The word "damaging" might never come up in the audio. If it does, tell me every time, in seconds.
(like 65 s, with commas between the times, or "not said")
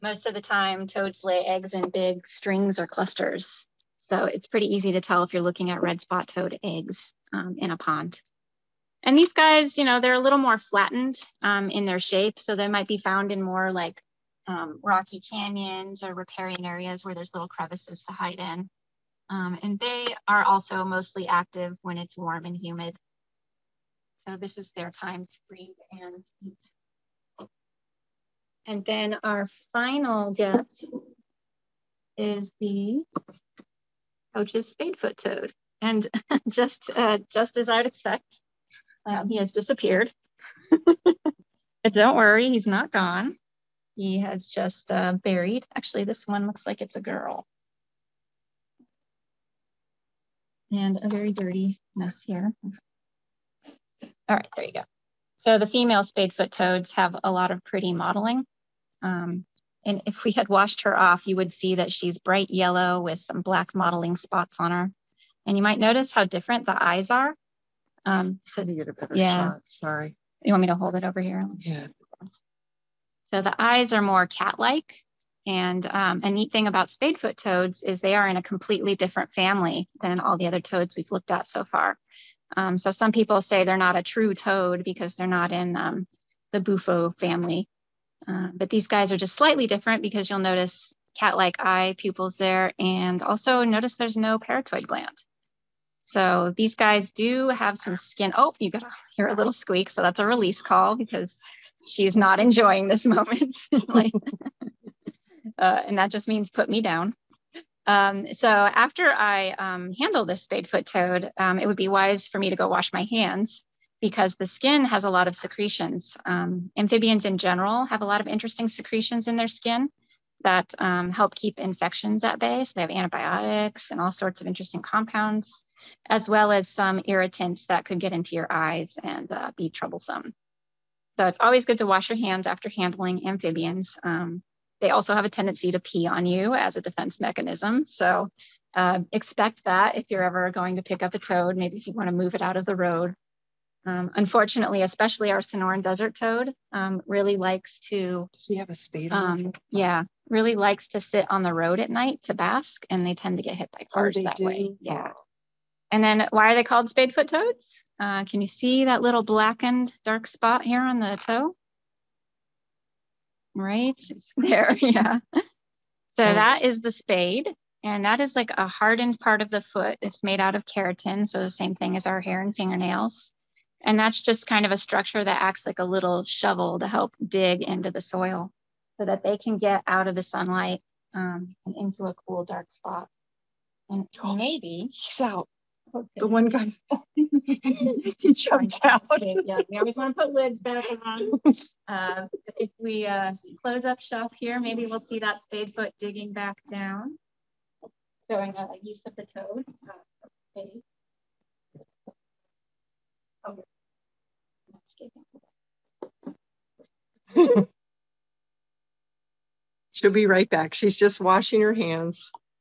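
not said.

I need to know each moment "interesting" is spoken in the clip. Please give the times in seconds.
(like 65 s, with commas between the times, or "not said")
118 s, 124 s.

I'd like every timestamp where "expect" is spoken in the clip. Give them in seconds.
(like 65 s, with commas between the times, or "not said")
37 s, 139 s.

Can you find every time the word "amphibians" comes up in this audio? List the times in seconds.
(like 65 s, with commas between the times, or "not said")
116 s, 133 s.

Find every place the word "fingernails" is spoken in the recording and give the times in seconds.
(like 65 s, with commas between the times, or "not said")
172 s.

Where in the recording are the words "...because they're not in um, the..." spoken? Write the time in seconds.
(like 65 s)
84 s.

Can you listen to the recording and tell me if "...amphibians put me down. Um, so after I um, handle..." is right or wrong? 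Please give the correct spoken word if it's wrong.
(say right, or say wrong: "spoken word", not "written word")
wrong: "means", not "amphibians".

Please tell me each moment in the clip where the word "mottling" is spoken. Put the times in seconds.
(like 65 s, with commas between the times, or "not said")
57 s, 63 s.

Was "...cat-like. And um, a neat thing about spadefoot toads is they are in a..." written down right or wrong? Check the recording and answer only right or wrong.
right.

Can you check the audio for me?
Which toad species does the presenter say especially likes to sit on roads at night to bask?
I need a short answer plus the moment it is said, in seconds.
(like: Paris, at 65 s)
Sonoran desert toad, at 145 s.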